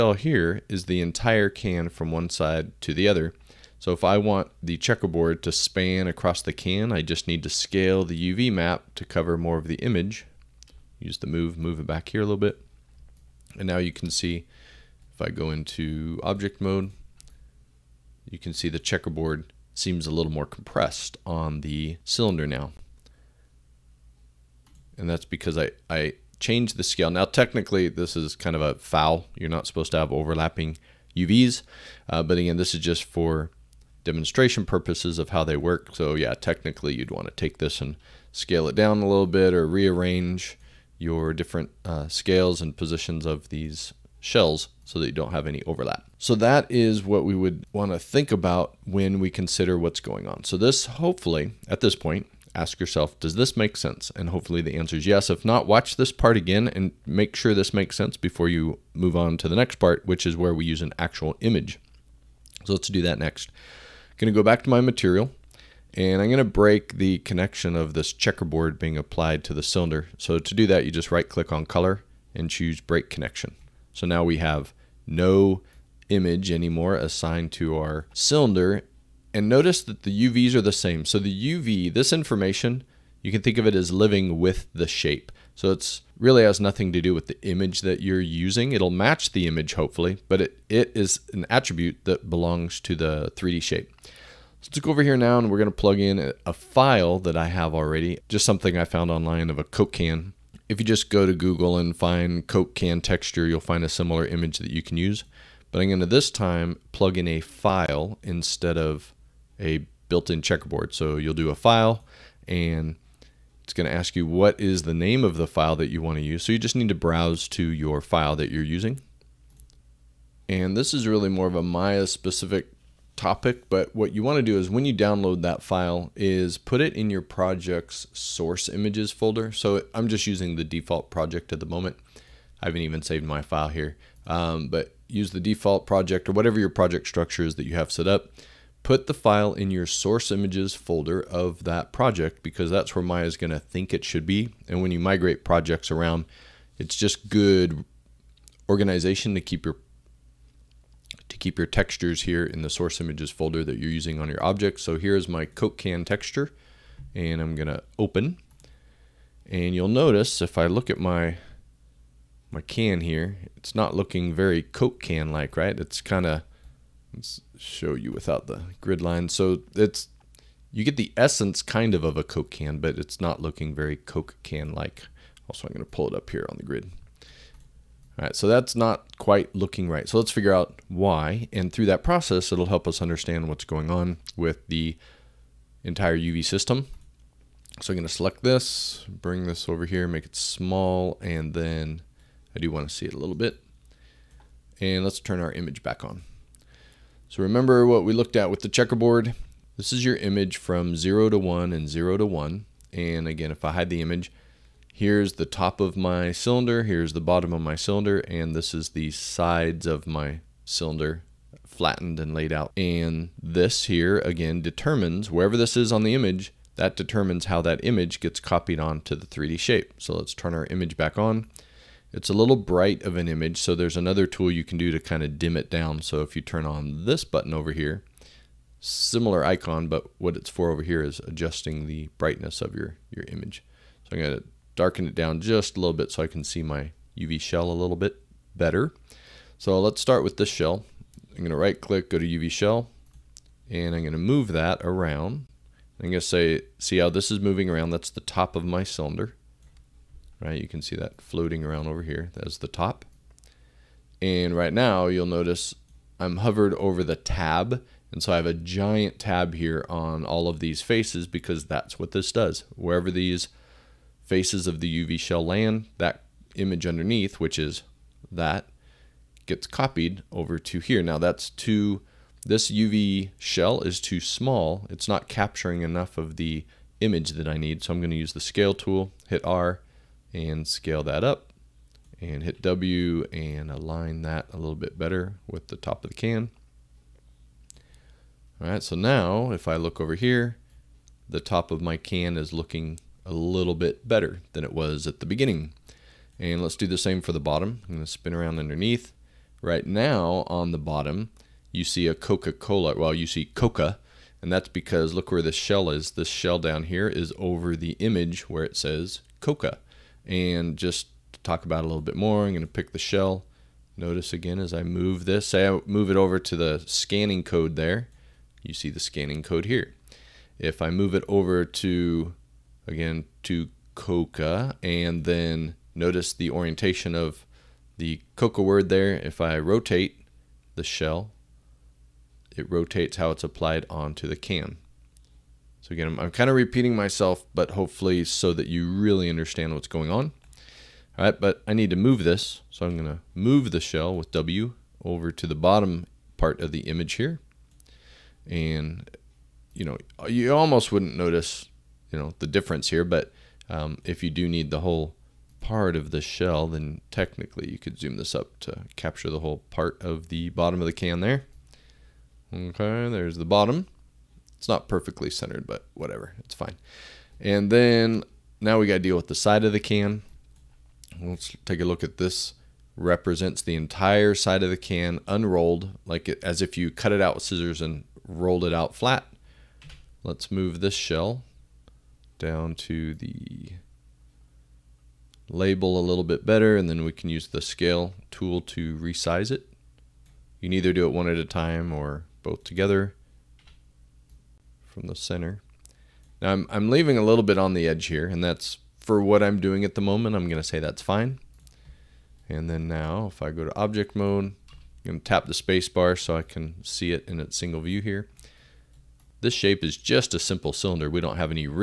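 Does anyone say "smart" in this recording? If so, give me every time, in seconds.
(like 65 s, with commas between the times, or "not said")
not said.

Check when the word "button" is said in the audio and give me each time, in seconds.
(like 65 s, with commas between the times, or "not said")
227 s.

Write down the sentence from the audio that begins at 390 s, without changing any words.
You can either do it one at a time or both together from the center.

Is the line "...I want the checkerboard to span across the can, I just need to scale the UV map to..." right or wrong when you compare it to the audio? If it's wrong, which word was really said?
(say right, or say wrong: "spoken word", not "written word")
right.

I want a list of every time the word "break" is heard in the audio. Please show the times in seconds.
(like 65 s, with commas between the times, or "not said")
66 s, 72 s.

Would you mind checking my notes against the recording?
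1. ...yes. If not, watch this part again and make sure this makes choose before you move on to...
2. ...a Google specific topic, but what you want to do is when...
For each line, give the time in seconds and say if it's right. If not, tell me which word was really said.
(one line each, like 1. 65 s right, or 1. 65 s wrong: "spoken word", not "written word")
1. 55 s wrong: "sense", not "choose"
2. 121 s wrong: "Maya", not "Google".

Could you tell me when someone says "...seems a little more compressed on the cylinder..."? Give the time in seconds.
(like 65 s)
19 s.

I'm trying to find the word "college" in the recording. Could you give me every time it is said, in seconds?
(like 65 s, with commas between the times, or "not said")
not said.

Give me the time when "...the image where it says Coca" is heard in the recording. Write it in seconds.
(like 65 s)
307 s.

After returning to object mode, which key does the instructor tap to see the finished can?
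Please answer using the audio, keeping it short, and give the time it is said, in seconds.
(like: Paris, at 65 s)
spacebar, at 405 s.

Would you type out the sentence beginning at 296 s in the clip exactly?
And let's do the same for the bottom.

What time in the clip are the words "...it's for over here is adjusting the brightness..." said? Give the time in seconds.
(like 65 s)
230 s.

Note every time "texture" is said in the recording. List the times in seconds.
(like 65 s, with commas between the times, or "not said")
102 s, 151 s, 156 s.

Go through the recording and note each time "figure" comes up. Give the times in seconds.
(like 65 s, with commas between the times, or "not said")
180 s.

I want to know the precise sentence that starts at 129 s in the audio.
So I'm just using the default project at the moment.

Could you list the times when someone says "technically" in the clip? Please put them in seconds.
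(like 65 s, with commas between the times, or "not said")
27 s, 36 s, 357 s.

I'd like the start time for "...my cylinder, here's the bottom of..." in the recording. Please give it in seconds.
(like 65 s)
205 s.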